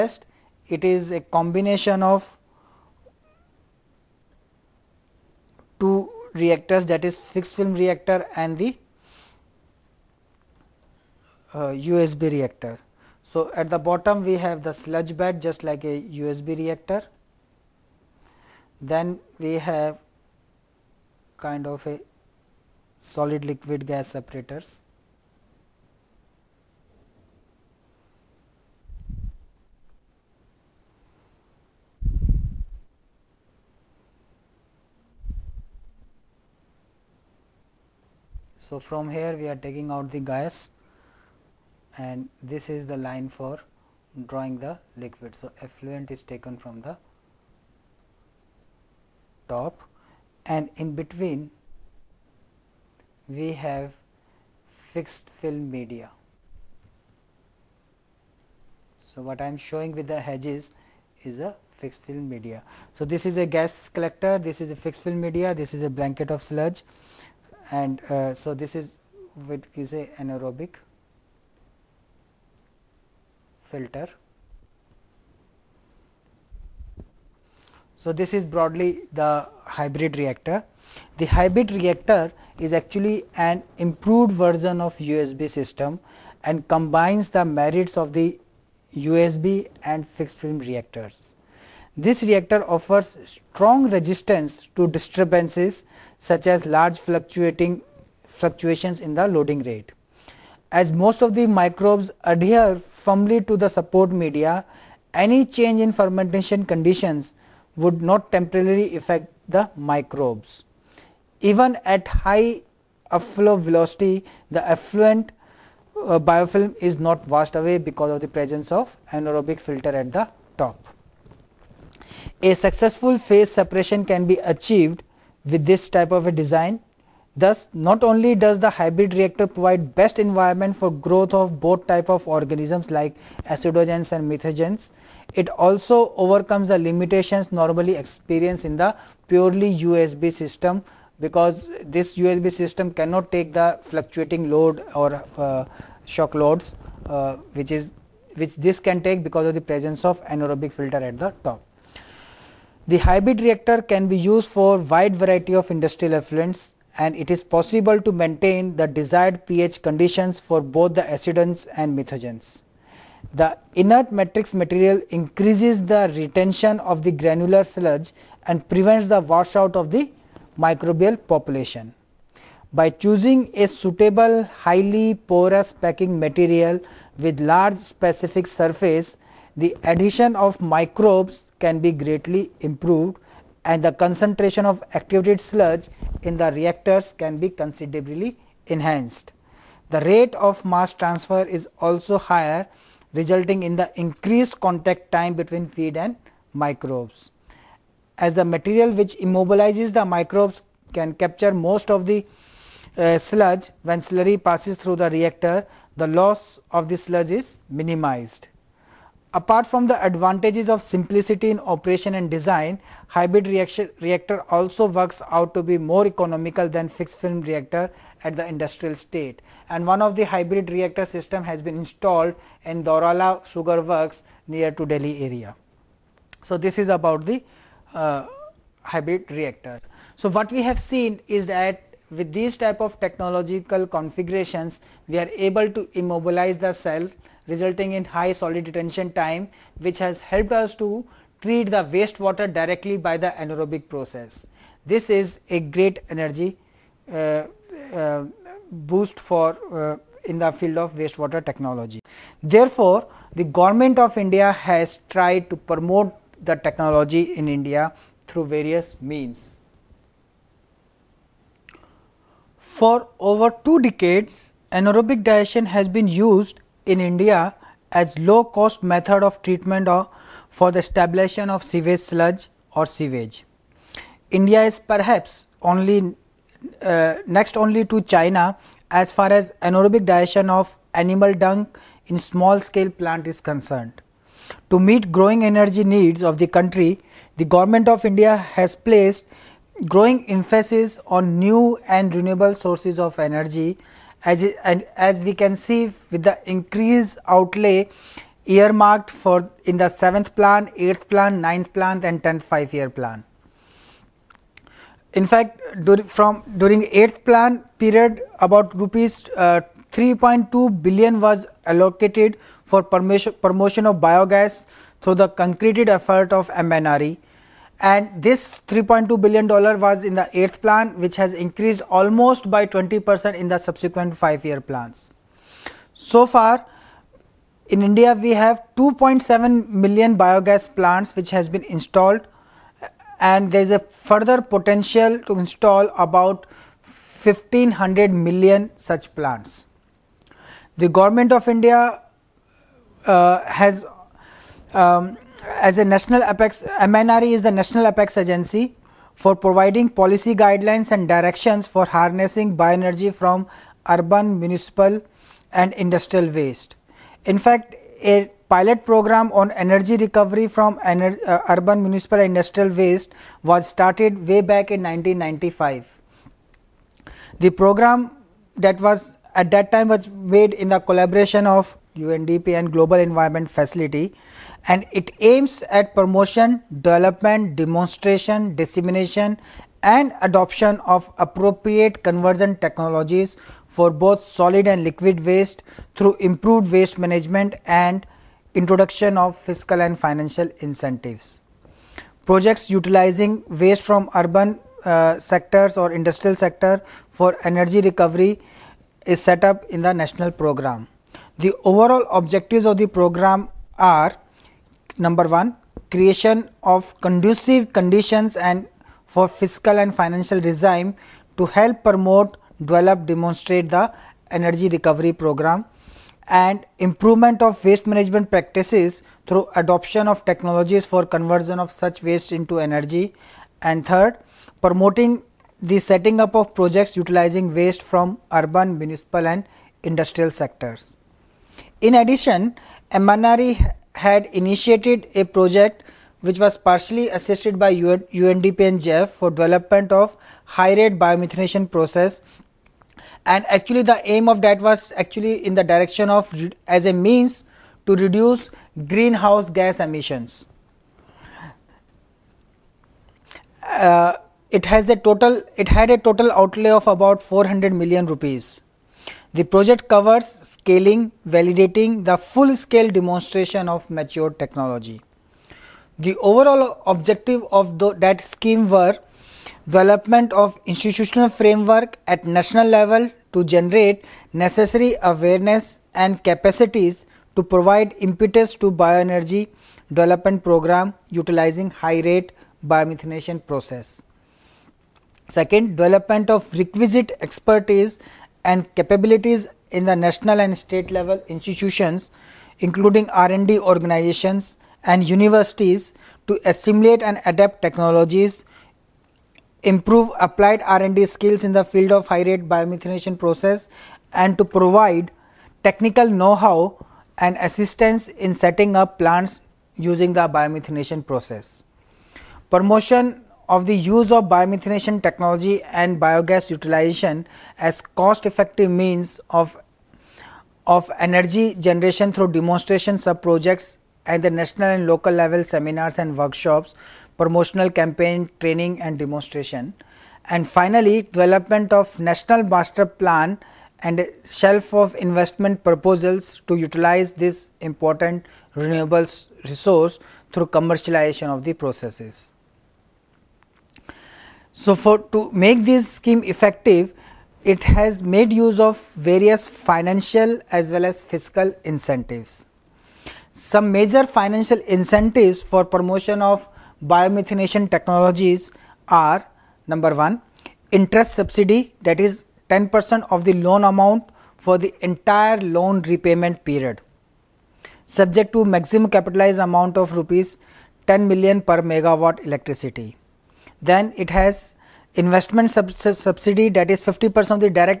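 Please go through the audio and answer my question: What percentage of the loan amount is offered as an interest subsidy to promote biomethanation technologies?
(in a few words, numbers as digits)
10 percent.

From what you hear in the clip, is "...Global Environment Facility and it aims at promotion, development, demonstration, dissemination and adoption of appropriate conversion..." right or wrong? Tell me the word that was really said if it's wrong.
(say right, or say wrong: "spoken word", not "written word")
right.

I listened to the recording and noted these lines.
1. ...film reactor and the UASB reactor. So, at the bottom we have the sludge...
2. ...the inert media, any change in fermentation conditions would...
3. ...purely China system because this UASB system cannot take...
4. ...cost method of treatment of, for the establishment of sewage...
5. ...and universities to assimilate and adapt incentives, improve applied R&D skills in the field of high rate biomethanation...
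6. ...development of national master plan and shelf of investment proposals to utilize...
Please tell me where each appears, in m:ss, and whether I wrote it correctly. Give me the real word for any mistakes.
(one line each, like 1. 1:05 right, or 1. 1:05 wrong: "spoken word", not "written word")
1. 0:07 right
2. 1:43 wrong: "support", not "inert"
3. 2:19 wrong: "UASB", not "China"
4. 4:28 right
5. 8:14 wrong: "technologies", not "incentives"
6. 8:51 right.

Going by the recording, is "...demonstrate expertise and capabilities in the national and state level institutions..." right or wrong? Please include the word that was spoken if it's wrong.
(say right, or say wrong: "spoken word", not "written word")
wrong: "requisite", not "demonstrate".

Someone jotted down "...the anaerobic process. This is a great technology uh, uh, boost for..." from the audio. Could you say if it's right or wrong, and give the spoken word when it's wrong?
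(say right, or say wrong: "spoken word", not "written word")
wrong: "energy", not "technology".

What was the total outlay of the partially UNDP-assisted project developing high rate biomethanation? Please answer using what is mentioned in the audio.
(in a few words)
400 million rupees.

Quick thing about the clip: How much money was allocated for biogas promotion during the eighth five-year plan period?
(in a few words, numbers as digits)
Rupees 3.2 billion.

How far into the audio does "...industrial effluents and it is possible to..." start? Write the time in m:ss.
2:35.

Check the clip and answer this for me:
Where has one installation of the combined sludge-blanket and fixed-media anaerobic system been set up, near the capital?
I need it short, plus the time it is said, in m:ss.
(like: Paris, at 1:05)
Daurala Sugar Works, at 3:42.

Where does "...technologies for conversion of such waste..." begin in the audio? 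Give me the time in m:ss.
7:00.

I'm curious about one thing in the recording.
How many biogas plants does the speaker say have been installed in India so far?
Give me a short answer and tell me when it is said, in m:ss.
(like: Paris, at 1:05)
2.7 million, at 5:28.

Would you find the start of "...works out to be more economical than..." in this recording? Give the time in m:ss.
3:34.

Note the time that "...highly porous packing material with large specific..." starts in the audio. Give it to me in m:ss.
2:54.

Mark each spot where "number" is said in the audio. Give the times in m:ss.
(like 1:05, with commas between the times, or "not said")
6:44, 9:19.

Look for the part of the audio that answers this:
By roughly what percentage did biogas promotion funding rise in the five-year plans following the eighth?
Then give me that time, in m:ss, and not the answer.
5:22.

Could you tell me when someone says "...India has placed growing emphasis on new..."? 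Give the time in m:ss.
4:48.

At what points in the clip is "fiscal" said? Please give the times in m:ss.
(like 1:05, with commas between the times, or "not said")
6:29, 6:49, 9:11.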